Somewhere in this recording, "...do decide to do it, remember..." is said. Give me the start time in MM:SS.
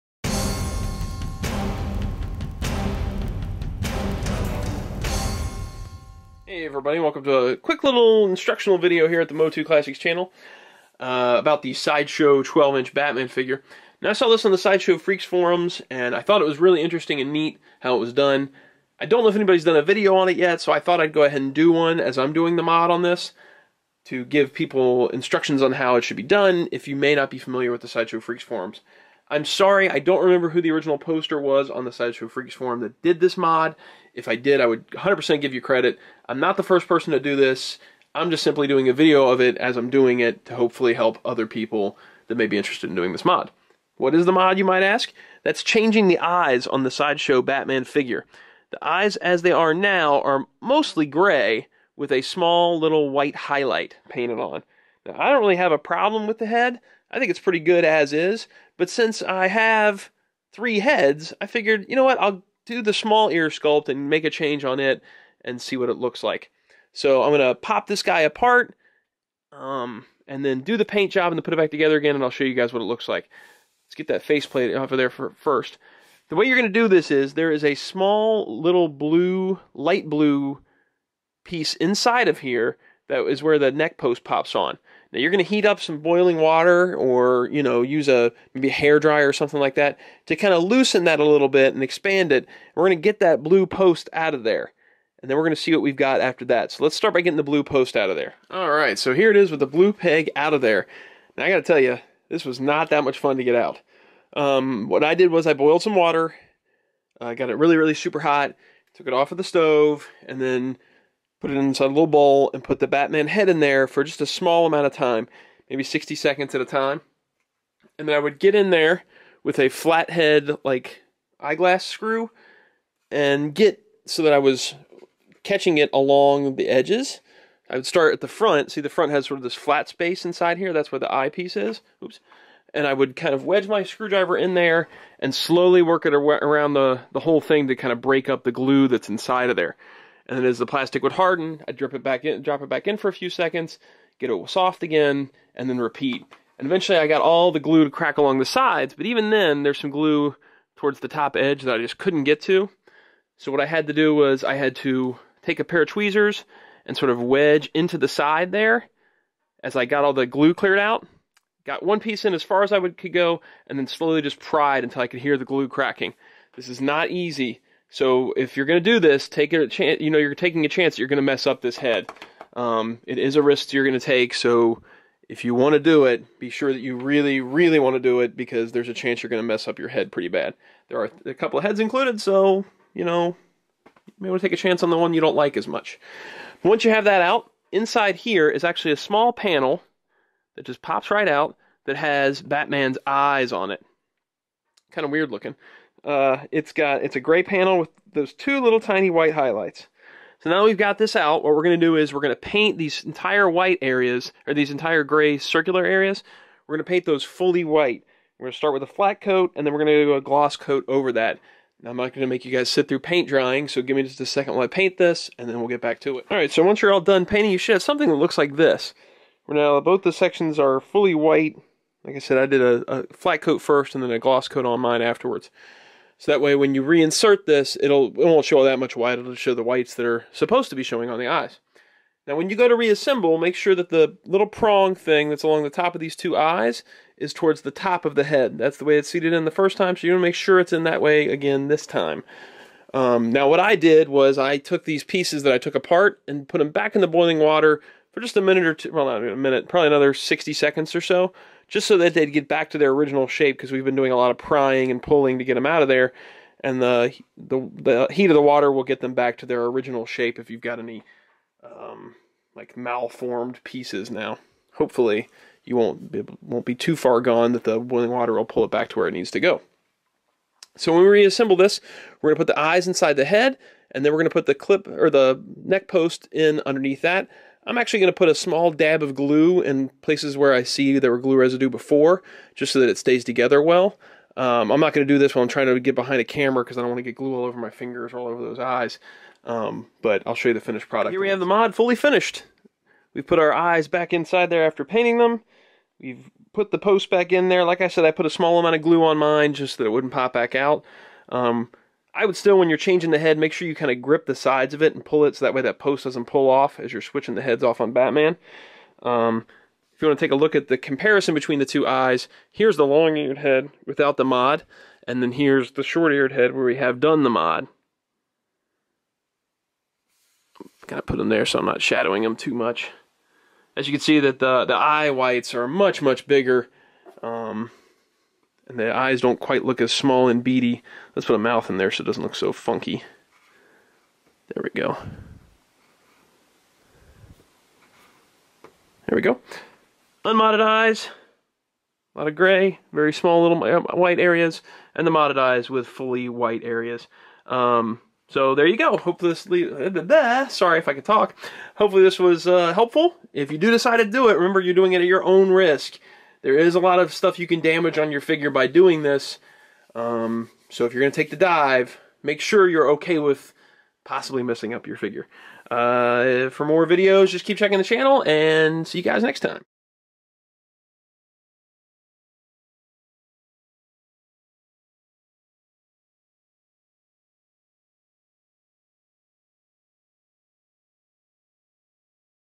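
05:53.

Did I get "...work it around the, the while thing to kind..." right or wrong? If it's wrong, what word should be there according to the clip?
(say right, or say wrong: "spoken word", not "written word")
wrong: "whole", not "while".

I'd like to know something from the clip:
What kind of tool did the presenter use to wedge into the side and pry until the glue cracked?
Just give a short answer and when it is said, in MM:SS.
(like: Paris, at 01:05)
tweezers, at 02:35.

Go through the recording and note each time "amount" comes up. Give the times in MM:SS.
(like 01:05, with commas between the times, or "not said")
01:54, 04:58.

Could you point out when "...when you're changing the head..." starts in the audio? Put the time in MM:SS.
05:02.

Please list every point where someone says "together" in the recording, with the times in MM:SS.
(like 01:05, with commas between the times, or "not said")
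01:11, 04:43.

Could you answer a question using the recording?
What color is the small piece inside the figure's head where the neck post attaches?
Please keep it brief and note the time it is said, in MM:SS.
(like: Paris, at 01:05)
light blue, at 01:19.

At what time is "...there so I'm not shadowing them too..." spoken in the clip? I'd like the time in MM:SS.
05:21.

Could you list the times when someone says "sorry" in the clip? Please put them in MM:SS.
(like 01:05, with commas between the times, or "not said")
00:29, 05:50.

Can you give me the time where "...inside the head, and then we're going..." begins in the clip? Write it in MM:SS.
04:32.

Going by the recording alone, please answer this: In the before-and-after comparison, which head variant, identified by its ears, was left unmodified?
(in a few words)
long eared head.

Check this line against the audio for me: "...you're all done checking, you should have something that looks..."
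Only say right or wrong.
wrong.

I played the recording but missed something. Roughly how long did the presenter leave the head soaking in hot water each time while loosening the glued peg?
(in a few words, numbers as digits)
60 seconds.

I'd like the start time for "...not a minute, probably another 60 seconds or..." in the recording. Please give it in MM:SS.
04:09.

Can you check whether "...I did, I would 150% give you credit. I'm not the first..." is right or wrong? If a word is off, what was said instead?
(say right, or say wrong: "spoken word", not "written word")
wrong: "100", not "150".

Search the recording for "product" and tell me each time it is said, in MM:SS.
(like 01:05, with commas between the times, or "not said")
04:50.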